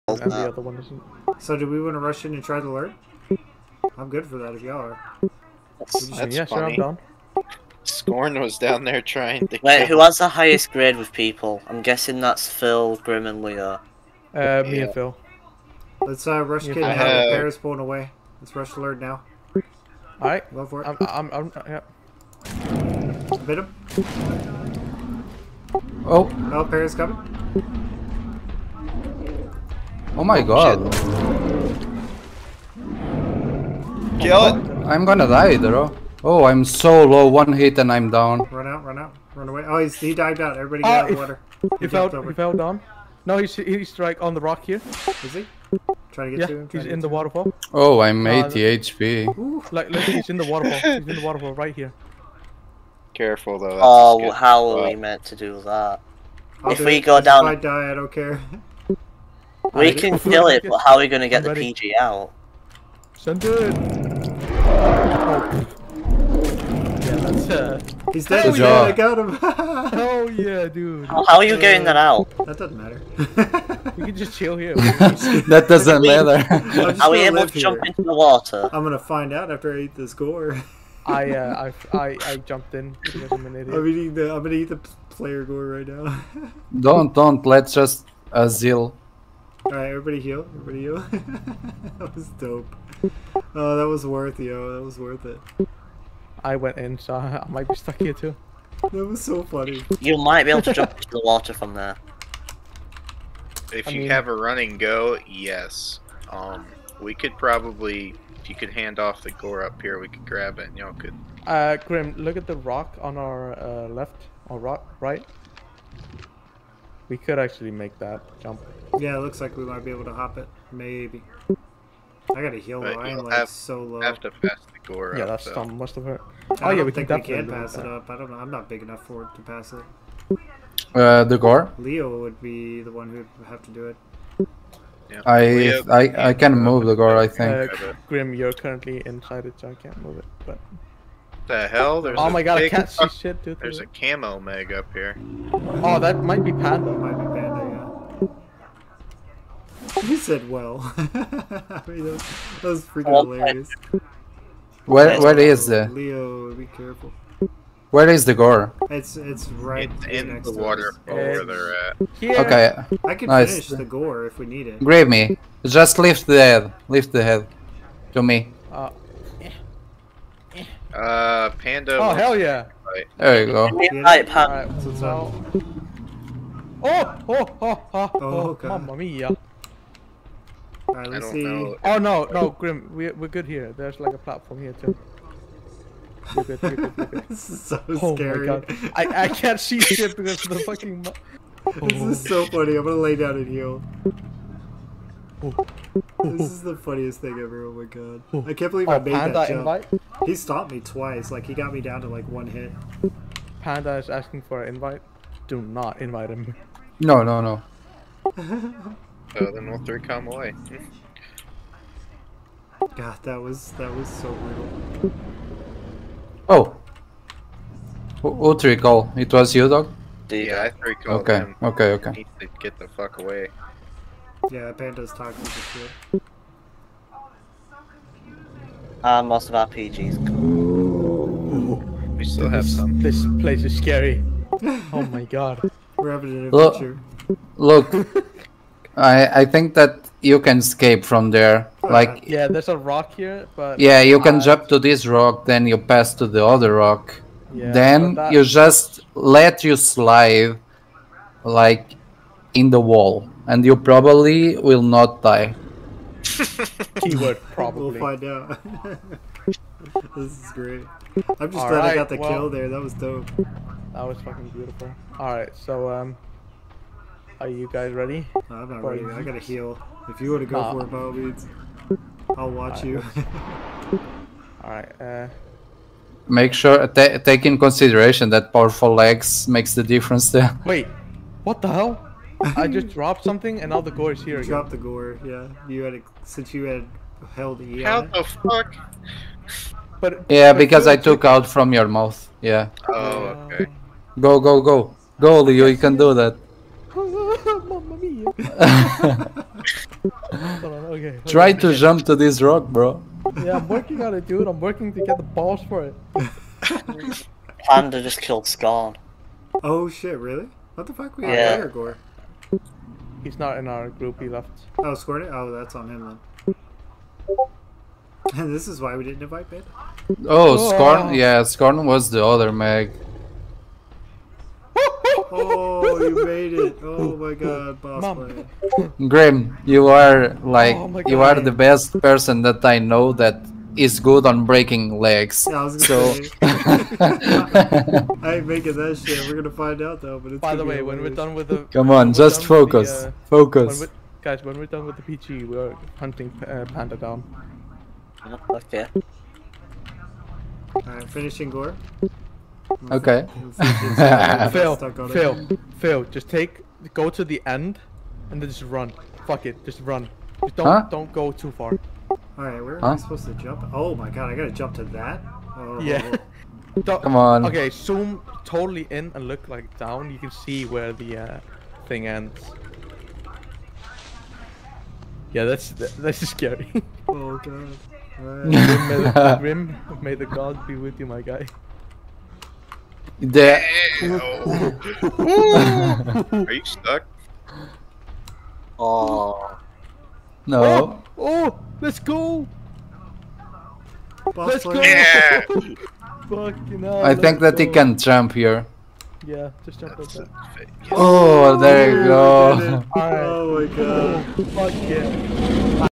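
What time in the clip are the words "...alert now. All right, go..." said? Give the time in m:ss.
0:18.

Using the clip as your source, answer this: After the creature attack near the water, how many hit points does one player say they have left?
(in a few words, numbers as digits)
80.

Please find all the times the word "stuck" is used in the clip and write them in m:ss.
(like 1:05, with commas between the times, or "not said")
1:37, 6:26.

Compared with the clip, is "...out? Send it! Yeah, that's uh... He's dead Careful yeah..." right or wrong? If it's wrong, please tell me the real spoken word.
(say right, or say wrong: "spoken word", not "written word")
wrong: "Hell", not "Careful".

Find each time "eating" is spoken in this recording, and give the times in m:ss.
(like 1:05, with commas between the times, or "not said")
1:23.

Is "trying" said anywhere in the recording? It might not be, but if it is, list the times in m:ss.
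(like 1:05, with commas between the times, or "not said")
0:09, 0:46.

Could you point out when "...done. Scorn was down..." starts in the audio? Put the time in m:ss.
0:06.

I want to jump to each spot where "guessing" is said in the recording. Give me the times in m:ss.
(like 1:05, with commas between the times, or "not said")
0:11.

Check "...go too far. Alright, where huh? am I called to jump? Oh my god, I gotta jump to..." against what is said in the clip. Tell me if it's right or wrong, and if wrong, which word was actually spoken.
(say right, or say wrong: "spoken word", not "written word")
wrong: "supposed", not "called".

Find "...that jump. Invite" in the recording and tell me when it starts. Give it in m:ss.
3:19.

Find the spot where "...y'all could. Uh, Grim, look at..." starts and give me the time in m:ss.
1:50.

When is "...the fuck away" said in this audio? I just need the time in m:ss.
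3:42.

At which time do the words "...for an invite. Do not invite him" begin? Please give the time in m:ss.
3:24.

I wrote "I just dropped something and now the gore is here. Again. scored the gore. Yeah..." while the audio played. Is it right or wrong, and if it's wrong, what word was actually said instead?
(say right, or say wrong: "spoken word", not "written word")
wrong: "dropped", not "scored".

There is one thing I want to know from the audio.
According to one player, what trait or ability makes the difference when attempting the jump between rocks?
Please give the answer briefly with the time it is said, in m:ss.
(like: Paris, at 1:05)
powerful legs, at 4:38.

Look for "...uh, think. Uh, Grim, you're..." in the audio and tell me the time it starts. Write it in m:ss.
2:17.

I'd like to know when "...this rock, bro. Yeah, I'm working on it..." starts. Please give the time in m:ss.
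5:02.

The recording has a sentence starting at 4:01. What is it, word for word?
Uh, like yeah, there's a rock here, but yeah, you can jump to this rock, then you pass to the other rock.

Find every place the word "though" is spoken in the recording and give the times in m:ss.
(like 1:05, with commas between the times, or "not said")
0:53, 2:02, 5:40.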